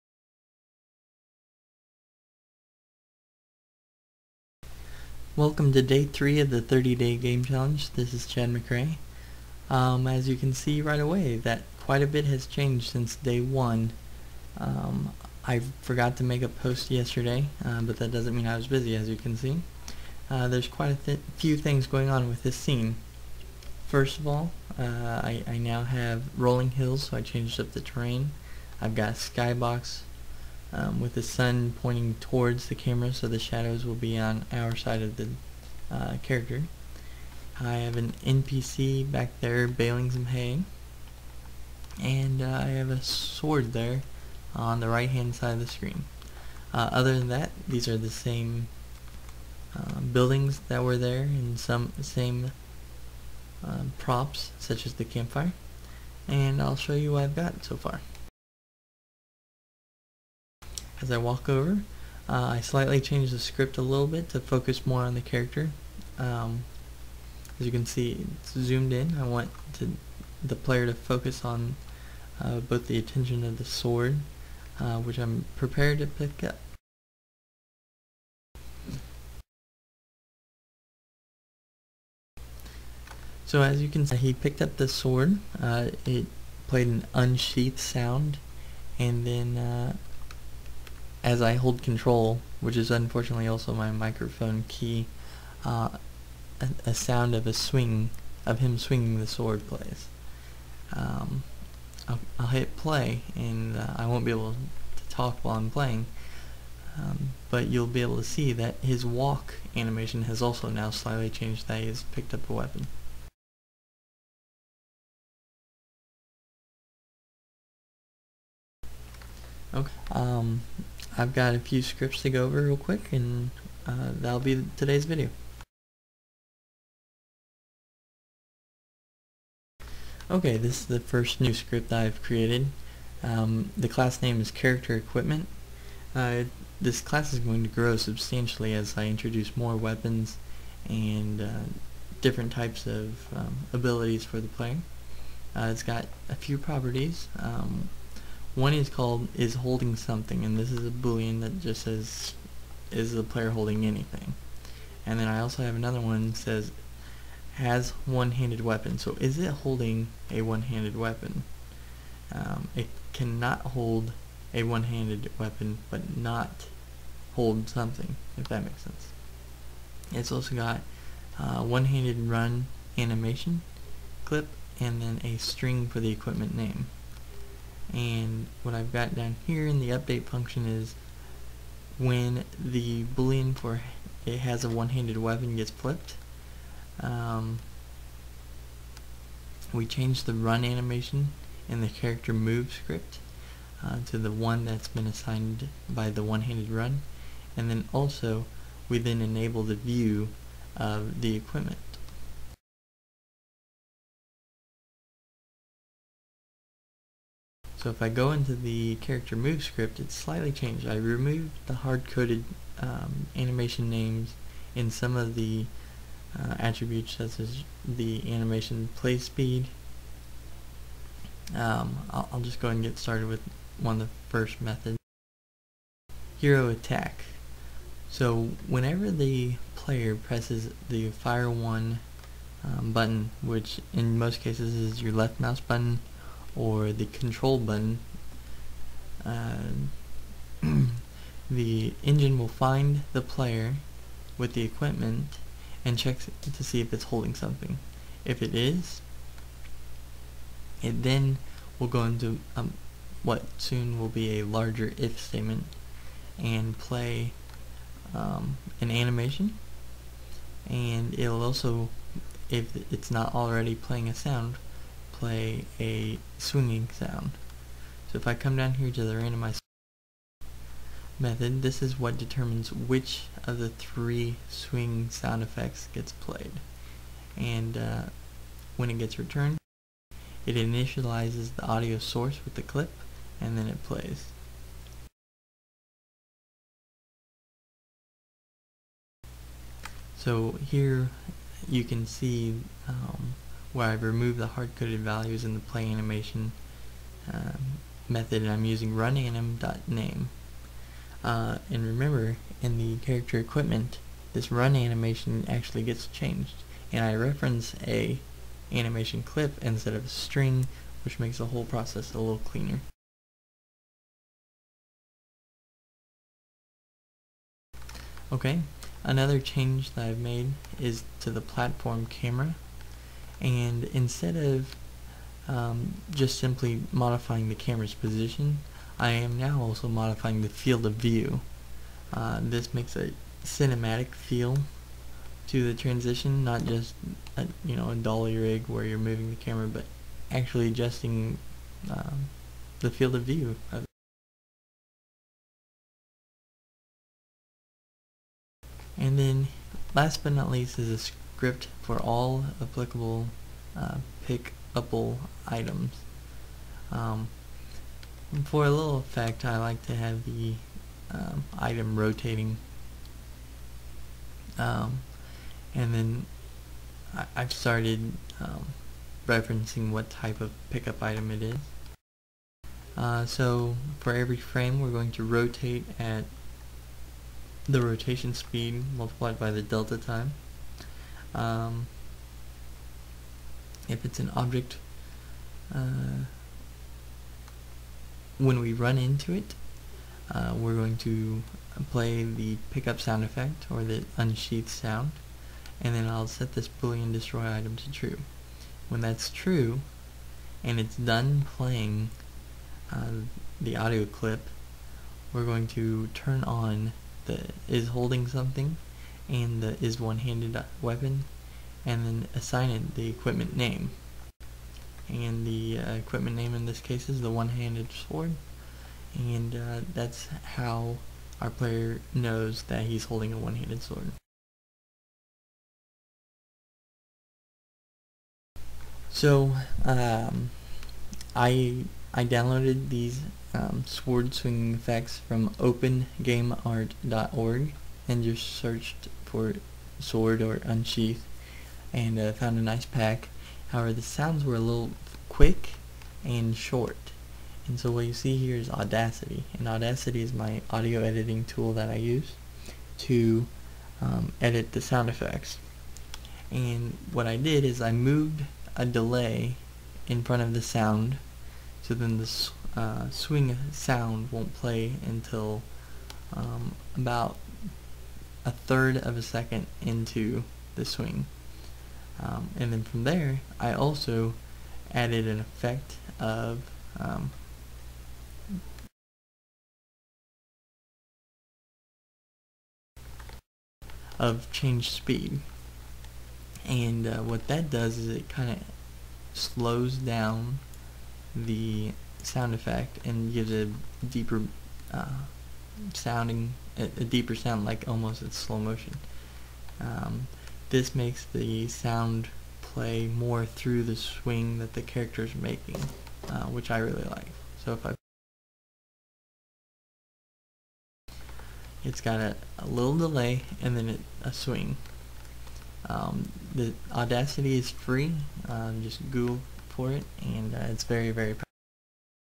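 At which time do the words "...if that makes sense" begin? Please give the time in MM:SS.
02:48.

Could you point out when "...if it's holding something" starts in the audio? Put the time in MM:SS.
04:06.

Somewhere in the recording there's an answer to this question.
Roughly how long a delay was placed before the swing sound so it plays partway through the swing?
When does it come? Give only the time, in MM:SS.
07:48.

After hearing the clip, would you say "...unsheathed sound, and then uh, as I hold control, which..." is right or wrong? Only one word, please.
right.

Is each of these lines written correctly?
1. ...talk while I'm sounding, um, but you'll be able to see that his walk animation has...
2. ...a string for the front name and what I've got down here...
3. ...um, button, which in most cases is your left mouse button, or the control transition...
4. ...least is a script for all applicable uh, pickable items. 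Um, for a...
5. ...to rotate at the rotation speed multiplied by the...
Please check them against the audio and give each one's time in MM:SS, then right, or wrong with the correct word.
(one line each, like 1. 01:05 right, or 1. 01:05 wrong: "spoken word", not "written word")
1. 01:45 wrong: "playing", not "sounding"
2. 02:55 wrong: "equipment", not "front"
3. 03:52 wrong: "button", not "transition"
4. 05:50 right
5. 06:15 right.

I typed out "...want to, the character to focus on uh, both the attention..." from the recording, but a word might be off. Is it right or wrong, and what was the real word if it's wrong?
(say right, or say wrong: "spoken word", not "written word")
wrong: "player", not "character".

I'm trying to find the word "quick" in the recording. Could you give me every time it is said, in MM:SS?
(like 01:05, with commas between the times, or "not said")
02:02, 07:25.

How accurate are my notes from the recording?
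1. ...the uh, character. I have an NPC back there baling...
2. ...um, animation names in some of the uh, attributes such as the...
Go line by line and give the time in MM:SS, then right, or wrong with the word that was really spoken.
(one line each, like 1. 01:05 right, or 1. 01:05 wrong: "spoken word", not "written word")
1. 00:35 right
2. 03:32 right.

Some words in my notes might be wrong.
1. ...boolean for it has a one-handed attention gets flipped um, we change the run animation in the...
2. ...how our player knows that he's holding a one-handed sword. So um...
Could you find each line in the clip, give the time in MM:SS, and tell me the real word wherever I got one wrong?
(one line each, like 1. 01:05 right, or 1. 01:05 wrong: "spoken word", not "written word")
1. 03:03 wrong: "weapon", not "attention"
2. 07:00 right.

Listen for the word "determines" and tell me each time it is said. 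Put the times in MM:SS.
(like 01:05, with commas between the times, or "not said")
04:32.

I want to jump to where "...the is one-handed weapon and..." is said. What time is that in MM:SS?
06:49.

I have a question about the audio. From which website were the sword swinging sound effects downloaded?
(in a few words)
OpenGameArt.org.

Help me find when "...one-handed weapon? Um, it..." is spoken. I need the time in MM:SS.
02:40.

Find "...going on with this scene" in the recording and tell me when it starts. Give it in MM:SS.
00:21.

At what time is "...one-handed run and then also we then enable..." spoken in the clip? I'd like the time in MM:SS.
03:16.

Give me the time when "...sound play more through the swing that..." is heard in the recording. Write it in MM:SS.
08:21.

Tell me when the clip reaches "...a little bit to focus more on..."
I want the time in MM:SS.
01:03.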